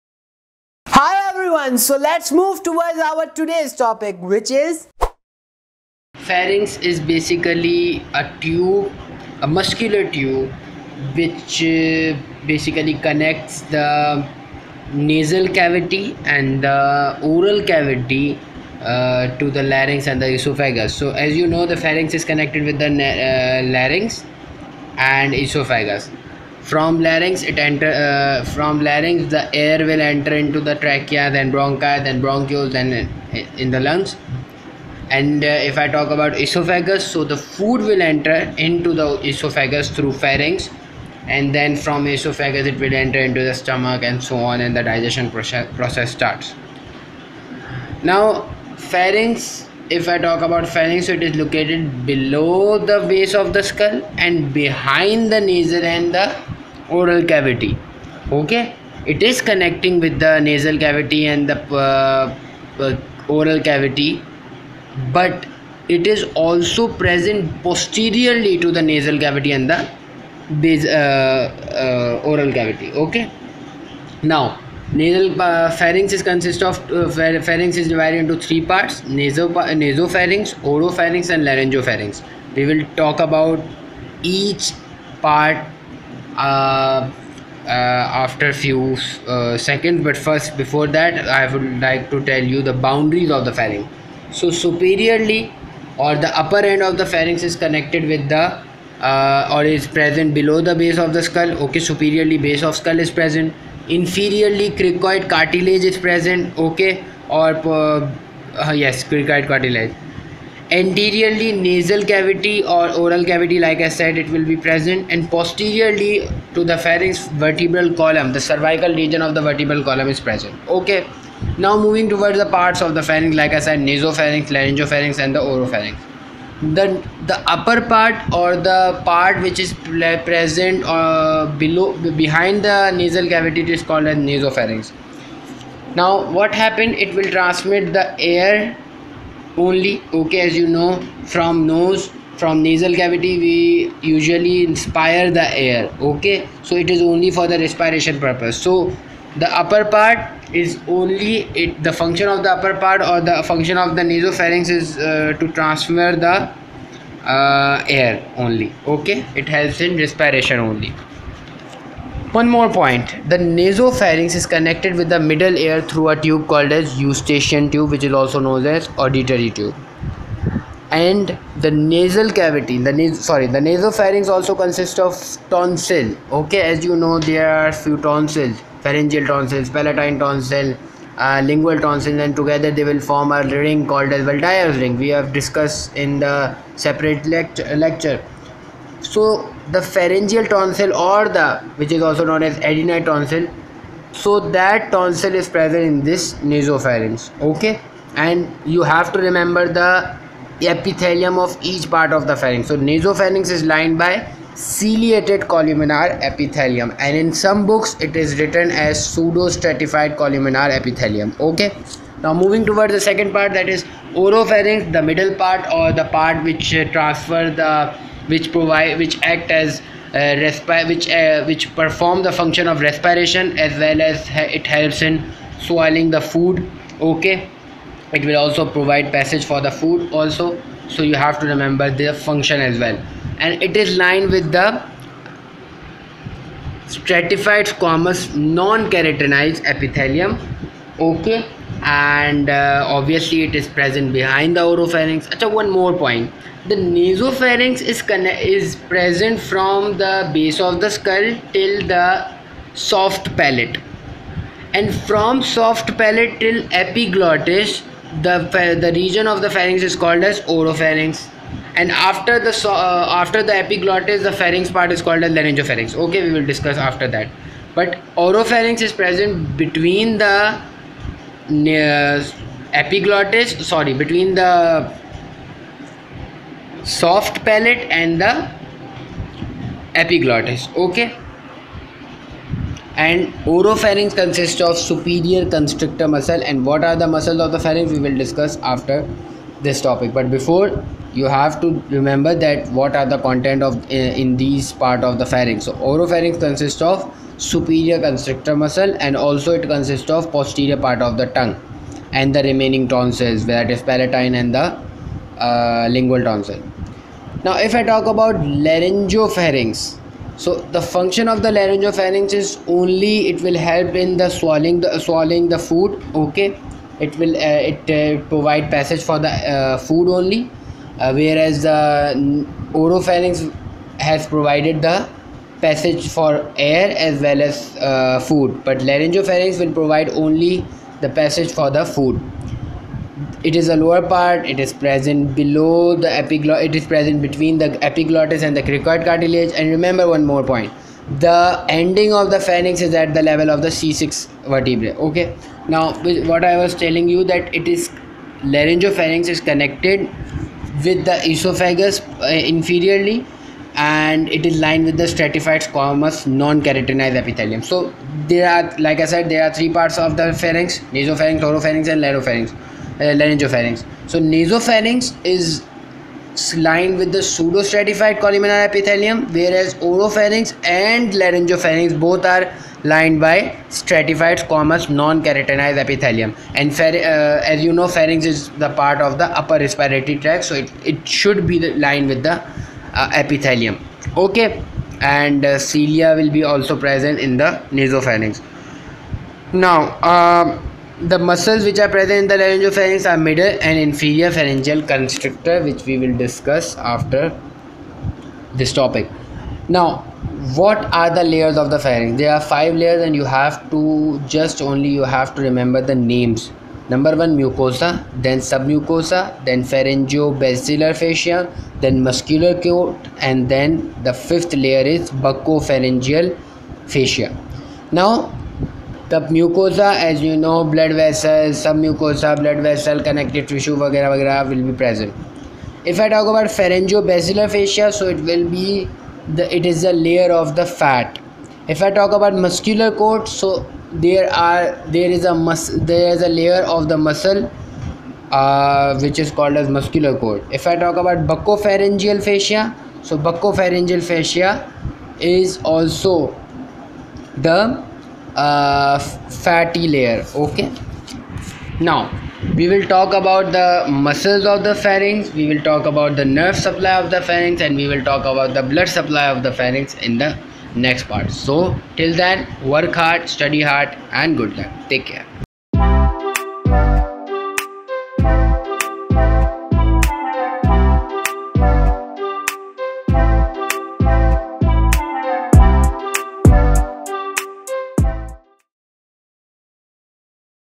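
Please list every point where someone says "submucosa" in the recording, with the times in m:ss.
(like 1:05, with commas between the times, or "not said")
6:48, 7:01.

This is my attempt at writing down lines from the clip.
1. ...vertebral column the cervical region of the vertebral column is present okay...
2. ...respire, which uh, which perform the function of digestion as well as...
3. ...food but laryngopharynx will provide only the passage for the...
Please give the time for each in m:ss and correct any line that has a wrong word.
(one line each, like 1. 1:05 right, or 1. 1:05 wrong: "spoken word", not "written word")
1. 1:57 right
2. 3:40 wrong: "respiration", not "digestion"
3. 5:28 right.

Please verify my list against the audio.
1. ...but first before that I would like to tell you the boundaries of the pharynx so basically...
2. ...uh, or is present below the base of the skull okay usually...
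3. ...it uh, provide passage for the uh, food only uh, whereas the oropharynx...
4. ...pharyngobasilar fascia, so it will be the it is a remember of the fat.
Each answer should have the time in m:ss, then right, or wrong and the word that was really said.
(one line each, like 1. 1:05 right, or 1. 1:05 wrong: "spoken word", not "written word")
1. 1:30 wrong: "superiorly", not "basically"
2. 1:39 wrong: "superiorly", not "usually"
3. 5:17 right
4. 7:06 wrong: "layer", not "remember".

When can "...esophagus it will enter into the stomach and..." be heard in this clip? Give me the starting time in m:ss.
0:42.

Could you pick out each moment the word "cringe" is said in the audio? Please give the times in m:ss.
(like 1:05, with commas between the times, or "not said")
not said.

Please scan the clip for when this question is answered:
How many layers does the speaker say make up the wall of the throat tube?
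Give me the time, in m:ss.
6:42.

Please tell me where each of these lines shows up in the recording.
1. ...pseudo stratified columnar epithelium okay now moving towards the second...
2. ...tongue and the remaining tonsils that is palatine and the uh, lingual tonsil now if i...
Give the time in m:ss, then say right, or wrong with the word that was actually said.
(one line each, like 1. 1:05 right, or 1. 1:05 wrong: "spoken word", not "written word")
1. 3:29 right
2. 5:01 right.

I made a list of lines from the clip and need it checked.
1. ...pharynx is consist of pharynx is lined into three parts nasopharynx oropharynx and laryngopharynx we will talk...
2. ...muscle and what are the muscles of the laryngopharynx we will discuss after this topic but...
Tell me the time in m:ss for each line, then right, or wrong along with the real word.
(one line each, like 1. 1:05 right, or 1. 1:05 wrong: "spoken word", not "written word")
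1. 1:15 wrong: "divided", not "lined"
2. 4:46 wrong: "pharynx", not "laryngopharynx".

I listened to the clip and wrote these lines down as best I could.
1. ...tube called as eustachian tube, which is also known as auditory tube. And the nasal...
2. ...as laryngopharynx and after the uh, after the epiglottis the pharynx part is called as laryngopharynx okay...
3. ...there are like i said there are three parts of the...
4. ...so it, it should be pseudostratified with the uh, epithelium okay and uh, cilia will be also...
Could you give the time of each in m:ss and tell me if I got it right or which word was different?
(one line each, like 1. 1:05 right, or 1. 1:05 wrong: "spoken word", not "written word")
1. 2:46 right
2. 4:20 wrong: "oropharynx", not "laryngopharynx"
3. 5:58 right
4. 6:20 wrong: "lined", not "pseudostratified".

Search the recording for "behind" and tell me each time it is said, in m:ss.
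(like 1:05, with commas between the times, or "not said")
0:54, 2:12, 4:04.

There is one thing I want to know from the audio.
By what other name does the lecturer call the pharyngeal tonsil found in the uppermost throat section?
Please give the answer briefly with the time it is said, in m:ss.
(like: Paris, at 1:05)
Adenoid tonsil, at 3:12.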